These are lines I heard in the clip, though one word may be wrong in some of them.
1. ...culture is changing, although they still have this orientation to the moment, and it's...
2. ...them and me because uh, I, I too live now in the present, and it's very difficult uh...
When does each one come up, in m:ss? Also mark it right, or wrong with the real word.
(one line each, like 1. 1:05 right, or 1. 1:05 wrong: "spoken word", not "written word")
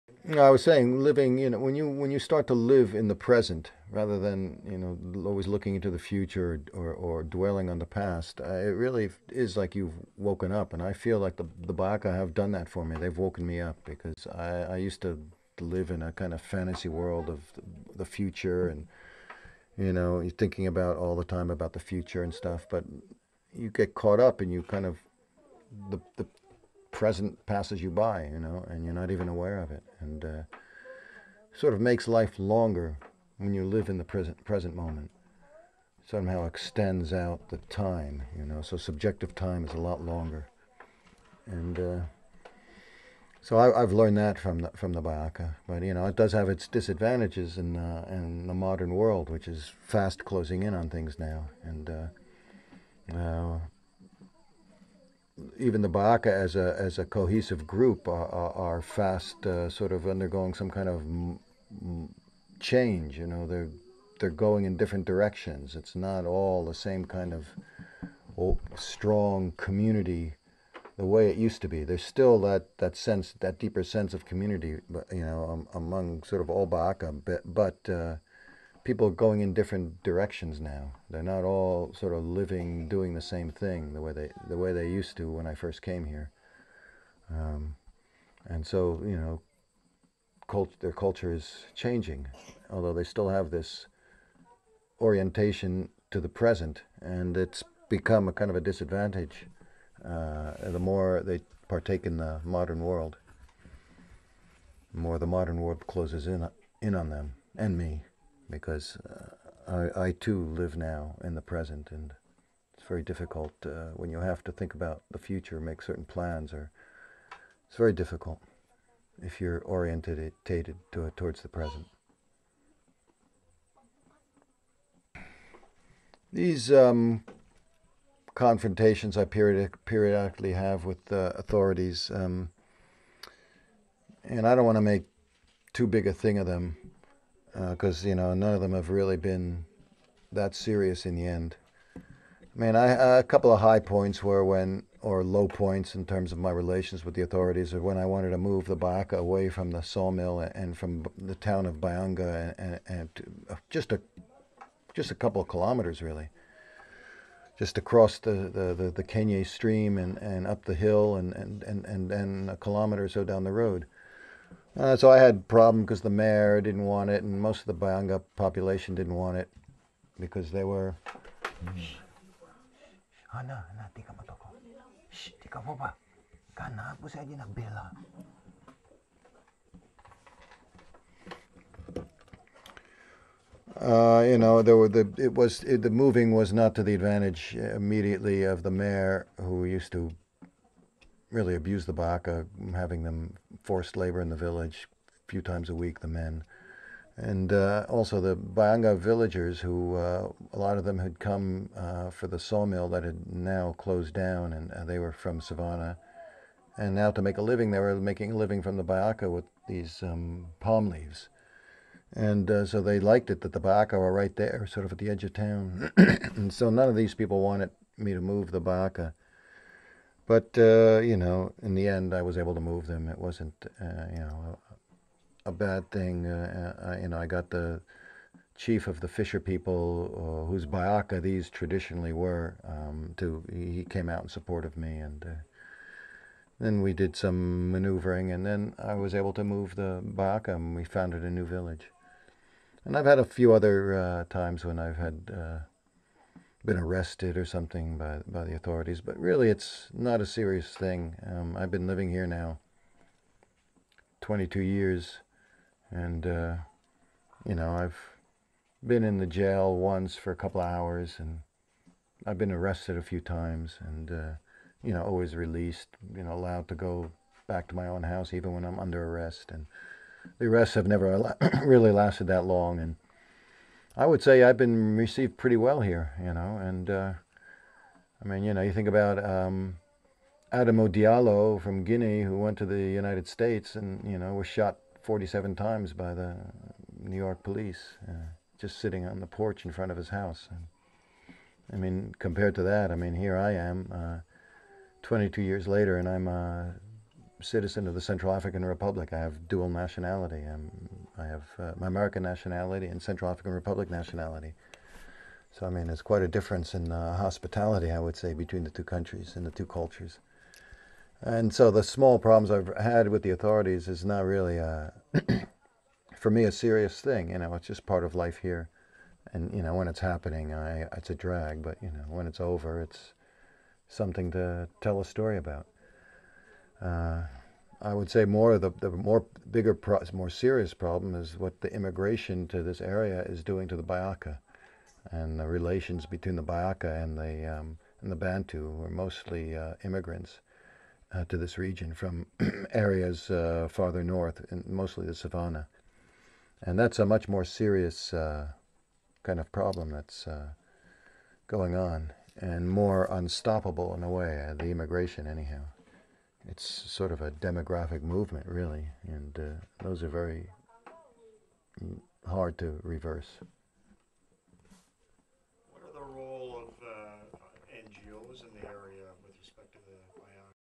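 1. 1:30 wrong: "present", not "moment"
2. 1:47 right.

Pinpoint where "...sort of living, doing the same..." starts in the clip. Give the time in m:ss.
1:21.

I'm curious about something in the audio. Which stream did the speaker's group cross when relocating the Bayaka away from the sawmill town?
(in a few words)
Kenya stream.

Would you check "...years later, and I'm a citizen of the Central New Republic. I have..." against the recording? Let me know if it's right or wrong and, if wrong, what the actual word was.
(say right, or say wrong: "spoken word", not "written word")
wrong: "African", not "New".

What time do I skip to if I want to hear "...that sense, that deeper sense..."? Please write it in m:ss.
1:12.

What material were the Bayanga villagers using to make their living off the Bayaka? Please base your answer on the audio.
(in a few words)
palm leaves.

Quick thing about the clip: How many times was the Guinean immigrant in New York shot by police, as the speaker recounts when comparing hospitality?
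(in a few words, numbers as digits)
47.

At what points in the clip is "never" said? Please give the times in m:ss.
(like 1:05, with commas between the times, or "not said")
4:30.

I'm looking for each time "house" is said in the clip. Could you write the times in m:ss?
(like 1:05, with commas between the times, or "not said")
4:28, 4:50.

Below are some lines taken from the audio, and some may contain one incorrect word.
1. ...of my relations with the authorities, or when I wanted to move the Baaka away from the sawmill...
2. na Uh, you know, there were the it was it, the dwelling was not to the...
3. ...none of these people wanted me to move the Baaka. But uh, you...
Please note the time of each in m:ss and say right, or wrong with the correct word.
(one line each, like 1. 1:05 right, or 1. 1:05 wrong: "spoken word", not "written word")
1. 2:26 right
2. 2:56 wrong: "moving", not "dwelling"
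3. 3:36 right.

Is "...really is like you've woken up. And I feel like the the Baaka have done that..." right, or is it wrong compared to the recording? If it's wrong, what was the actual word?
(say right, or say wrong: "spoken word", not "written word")
right.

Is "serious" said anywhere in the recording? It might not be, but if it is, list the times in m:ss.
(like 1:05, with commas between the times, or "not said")
2:20, 4:10, 5:16, 5:30, 5:47.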